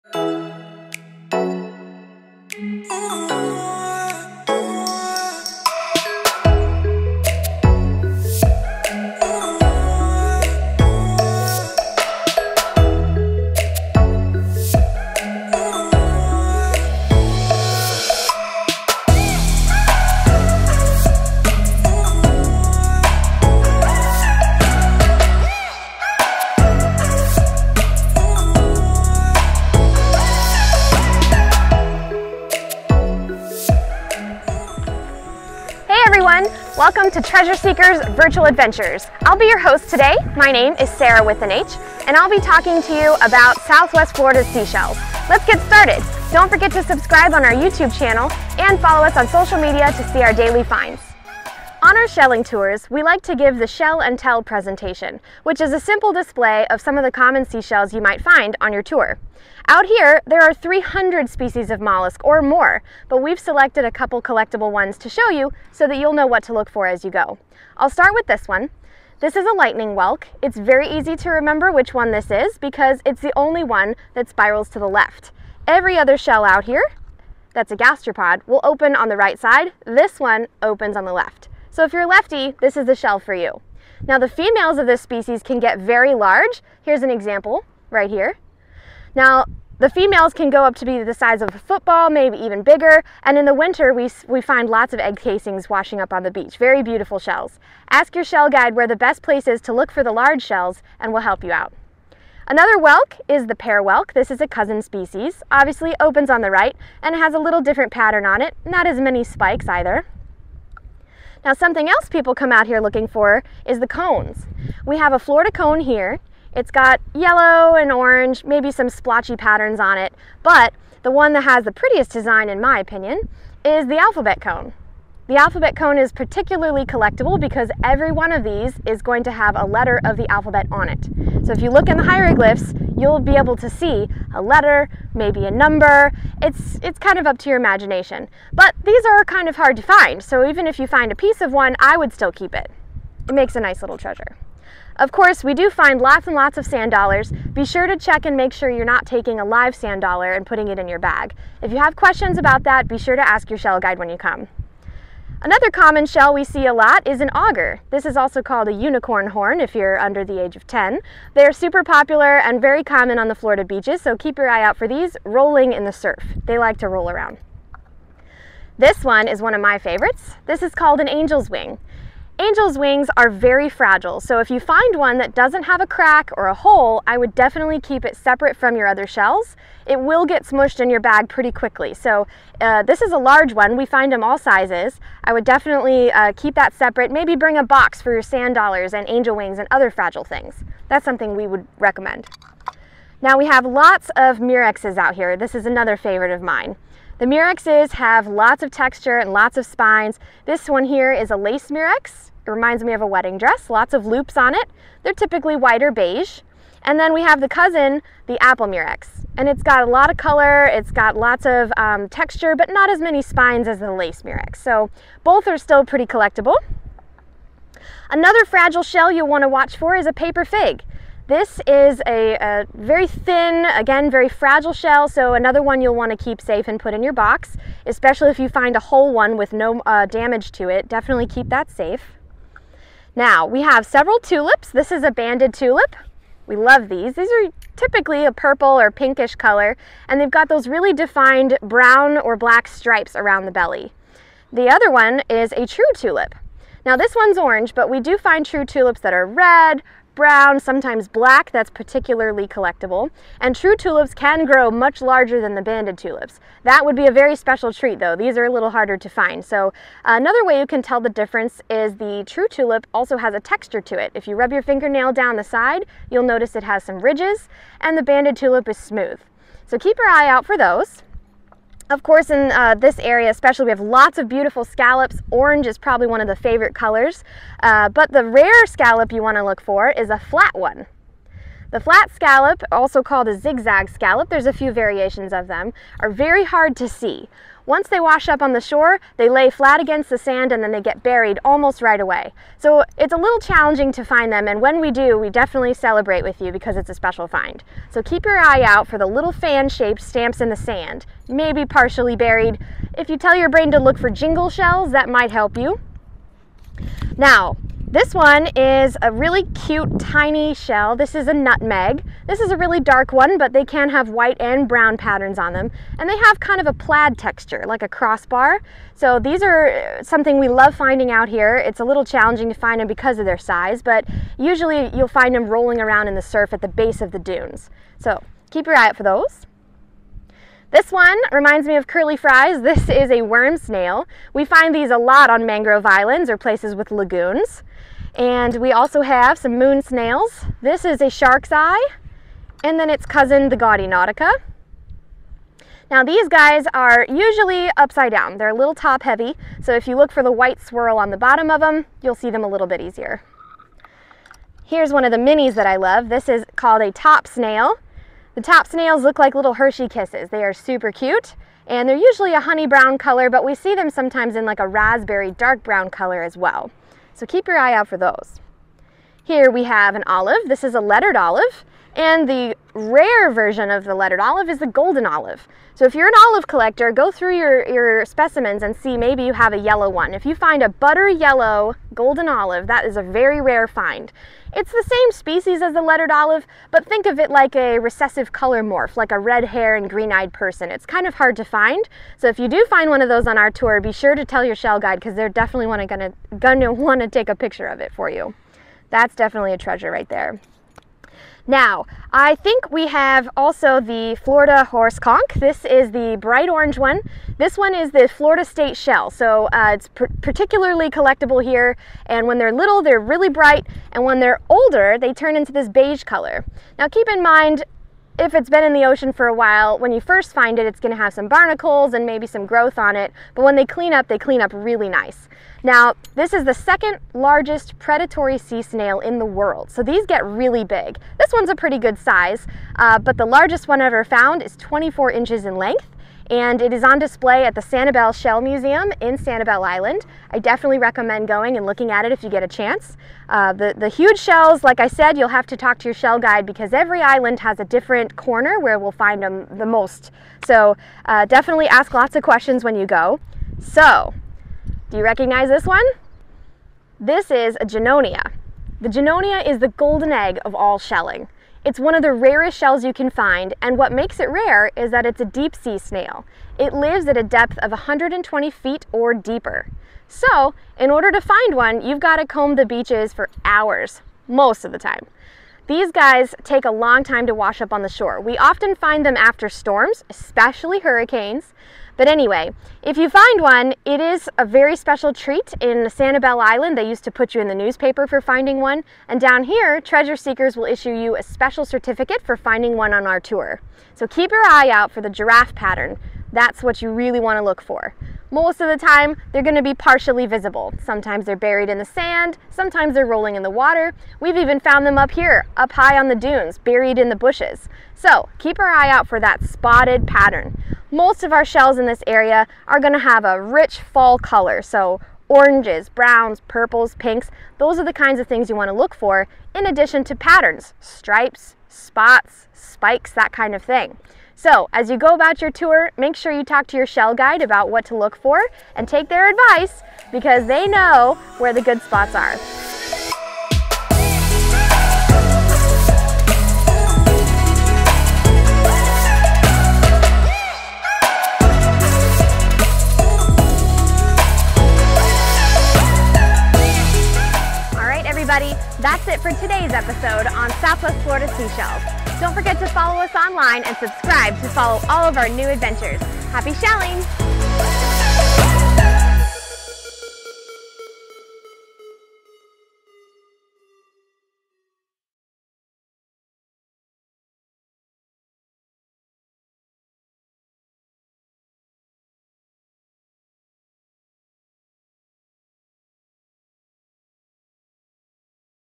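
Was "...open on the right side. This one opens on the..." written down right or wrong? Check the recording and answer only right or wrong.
right.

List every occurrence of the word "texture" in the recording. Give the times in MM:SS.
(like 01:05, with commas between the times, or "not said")
03:18, 03:32, 04:23, 05:17.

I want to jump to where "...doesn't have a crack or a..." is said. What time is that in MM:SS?
02:55.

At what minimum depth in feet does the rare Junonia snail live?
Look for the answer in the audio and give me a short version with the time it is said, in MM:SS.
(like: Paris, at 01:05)
120 feet, at 07:47.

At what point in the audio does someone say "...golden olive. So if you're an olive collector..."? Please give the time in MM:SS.
06:14.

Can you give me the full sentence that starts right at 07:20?
I definitely recommend going and looking at it if you get a chance.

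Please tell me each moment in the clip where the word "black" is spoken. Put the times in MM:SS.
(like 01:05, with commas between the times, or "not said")
04:02, 04:11.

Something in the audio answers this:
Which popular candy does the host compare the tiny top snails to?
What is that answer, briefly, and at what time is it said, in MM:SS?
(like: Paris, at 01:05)
Hershey Kisses, at 05:59.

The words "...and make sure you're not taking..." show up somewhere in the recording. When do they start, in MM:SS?
02:28.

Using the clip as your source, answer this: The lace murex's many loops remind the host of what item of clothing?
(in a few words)
Wedding dress.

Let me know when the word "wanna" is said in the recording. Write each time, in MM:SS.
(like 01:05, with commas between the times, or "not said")
06:36, 08:38.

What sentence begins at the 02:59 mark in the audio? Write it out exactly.
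It will get smushed in your bag pretty quickly.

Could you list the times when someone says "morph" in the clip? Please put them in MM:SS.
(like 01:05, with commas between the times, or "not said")
06:28.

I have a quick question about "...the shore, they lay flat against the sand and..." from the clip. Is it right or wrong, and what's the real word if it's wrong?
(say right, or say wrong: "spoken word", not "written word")
right.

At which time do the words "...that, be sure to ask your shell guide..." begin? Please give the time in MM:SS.
02:32.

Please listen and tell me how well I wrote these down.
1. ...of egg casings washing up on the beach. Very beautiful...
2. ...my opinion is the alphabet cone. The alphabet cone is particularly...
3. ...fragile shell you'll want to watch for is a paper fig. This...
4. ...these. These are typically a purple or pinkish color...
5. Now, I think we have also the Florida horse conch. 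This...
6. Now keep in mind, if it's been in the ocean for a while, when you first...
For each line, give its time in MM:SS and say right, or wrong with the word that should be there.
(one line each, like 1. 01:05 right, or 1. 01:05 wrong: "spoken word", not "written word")
1. 01:34 right
2. 02:02 right
3. 03:38 right
4. 03:56 right
5. 06:41 right
6. 06:56 right.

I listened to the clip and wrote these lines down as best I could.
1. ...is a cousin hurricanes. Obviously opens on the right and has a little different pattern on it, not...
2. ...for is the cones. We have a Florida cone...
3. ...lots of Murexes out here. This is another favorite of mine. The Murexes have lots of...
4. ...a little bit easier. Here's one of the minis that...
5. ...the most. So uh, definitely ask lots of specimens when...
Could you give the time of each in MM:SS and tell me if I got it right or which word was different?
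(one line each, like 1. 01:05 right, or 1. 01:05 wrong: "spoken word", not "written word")
1. 01:44 wrong: "species", not "hurricanes"
2. 01:53 right
3. 03:13 right
4. 05:52 right
5. 07:29 wrong: "questions", not "specimens".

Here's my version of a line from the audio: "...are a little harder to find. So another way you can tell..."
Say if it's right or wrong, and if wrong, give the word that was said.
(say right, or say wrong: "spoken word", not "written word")
right.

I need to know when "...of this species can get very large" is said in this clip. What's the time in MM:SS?
01:24.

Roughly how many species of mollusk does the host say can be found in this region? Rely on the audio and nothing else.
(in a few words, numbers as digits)
300.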